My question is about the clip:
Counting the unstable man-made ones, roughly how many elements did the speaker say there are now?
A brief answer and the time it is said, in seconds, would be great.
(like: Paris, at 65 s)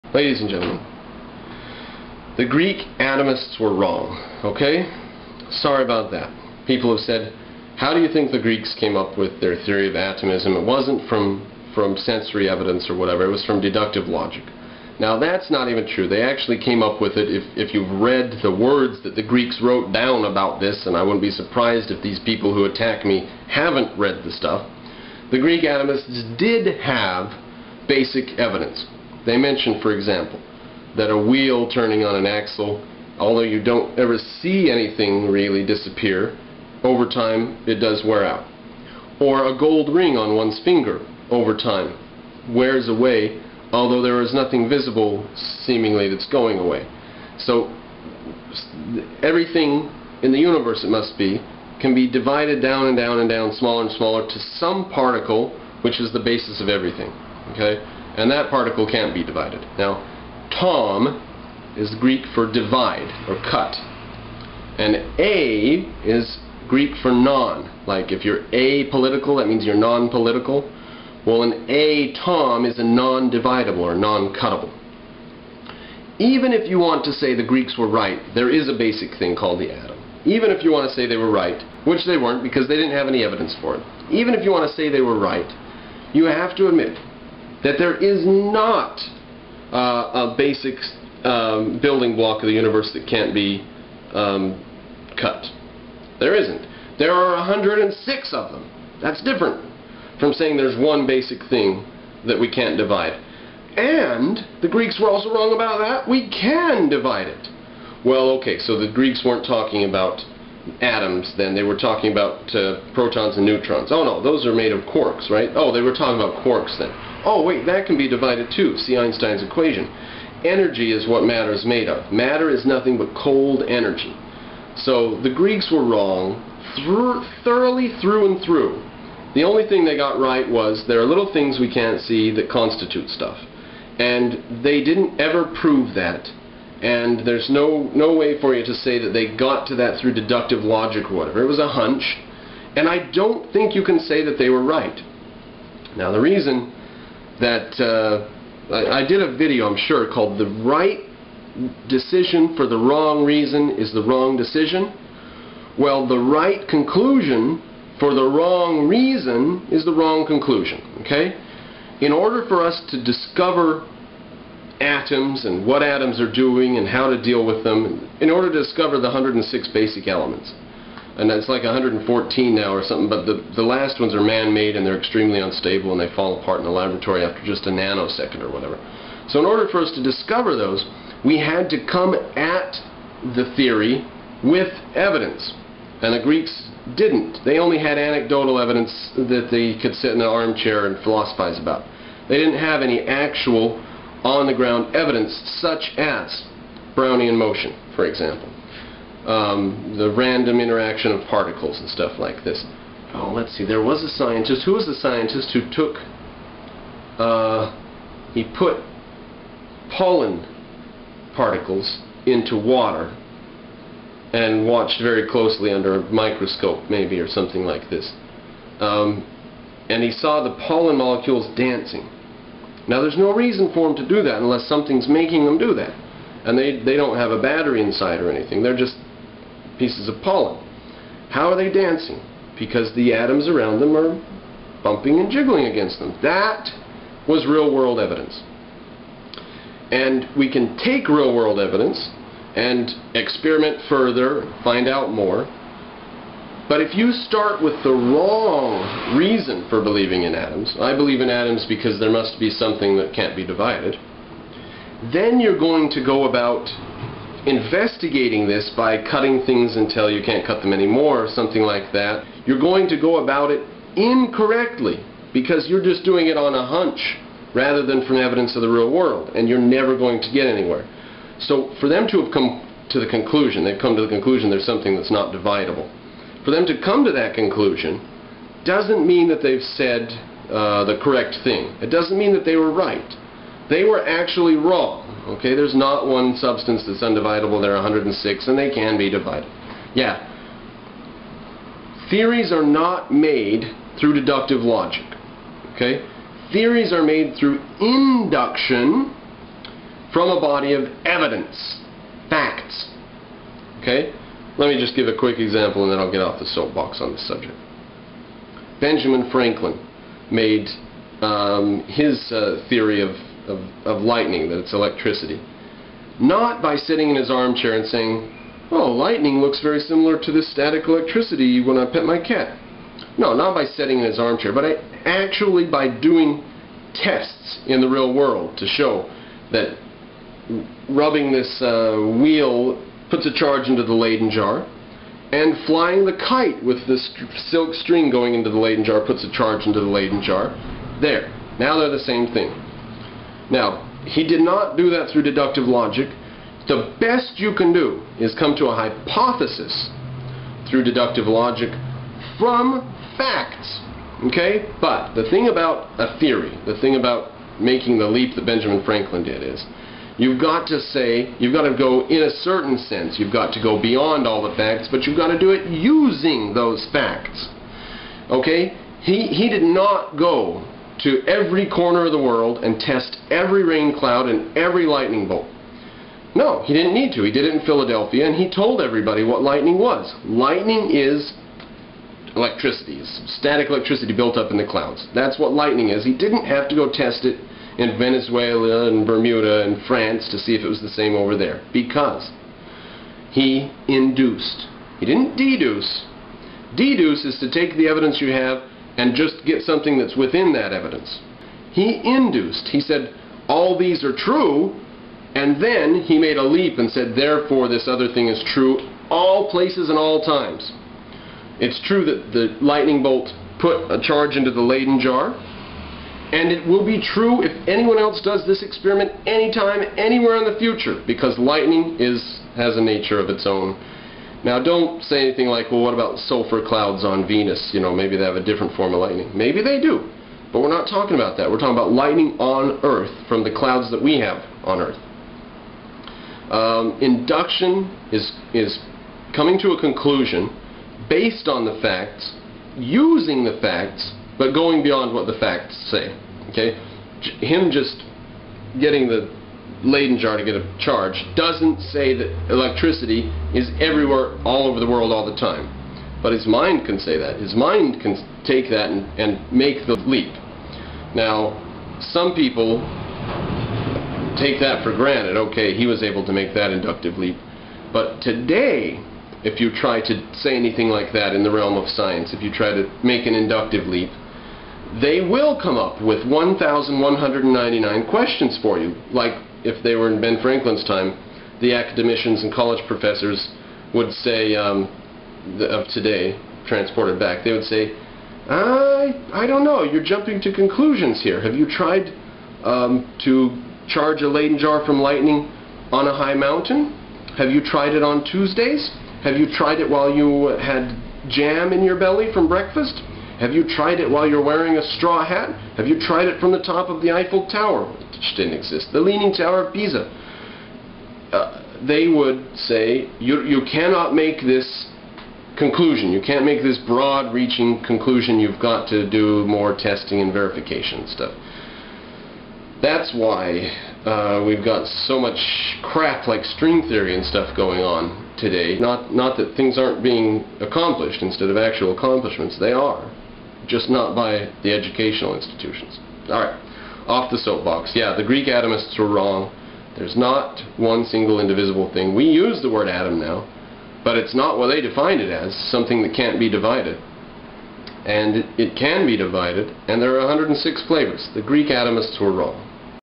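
114, at 171 s.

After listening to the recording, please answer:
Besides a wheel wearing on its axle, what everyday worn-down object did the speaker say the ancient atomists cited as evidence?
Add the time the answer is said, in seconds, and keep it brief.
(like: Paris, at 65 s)
A gold ring, at 39 s.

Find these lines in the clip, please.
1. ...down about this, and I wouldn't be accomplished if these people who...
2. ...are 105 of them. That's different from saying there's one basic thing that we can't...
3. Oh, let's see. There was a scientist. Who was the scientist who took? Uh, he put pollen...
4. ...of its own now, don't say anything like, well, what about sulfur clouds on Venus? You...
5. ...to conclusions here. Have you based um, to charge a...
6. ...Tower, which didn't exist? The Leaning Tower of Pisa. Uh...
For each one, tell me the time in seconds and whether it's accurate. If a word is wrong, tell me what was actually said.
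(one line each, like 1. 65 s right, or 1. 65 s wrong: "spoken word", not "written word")
1. 19 s wrong: "surprised", not "accomplished"
2. 97 s wrong: "106", not "105"
3. 203 s right
4. 423 s right
5. 490 s wrong: "tried", not "based"
6. 507 s right.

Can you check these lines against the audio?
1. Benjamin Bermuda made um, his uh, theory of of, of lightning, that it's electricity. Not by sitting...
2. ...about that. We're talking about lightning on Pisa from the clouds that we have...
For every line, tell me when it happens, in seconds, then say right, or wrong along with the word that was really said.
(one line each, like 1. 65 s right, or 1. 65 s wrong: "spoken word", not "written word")
1. 308 s wrong: "Franklin", not "Bermuda"
2. 431 s wrong: "Earth", not "Pisa".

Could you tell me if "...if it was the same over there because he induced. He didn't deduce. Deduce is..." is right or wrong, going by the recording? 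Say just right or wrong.
right.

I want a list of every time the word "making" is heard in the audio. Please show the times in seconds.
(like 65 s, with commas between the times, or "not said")
225 s, 357 s.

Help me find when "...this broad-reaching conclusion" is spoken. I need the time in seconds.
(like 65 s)
516 s.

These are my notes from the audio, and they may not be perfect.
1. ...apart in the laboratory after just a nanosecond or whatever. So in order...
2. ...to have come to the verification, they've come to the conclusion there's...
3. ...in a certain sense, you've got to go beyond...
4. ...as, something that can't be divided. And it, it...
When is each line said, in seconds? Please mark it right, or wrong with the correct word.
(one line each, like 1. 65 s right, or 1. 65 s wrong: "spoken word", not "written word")
1. 176 s right
2. 272 s wrong: "conclusion", not "verification"
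3. 362 s right
4. 545 s right.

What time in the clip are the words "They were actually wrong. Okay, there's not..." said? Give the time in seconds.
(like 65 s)
283 s.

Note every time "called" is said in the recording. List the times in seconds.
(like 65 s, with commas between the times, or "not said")
79 s, 150 s.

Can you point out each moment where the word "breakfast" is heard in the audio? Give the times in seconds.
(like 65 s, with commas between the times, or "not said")
502 s.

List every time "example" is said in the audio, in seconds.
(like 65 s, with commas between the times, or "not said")
29 s, 198 s, 305 s.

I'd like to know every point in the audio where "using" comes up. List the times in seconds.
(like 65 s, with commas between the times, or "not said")
365 s, 442 s.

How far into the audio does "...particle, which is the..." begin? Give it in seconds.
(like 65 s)
54 s.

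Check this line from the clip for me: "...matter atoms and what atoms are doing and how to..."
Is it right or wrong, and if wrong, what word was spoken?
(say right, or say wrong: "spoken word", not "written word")
wrong: "discover", not "matter".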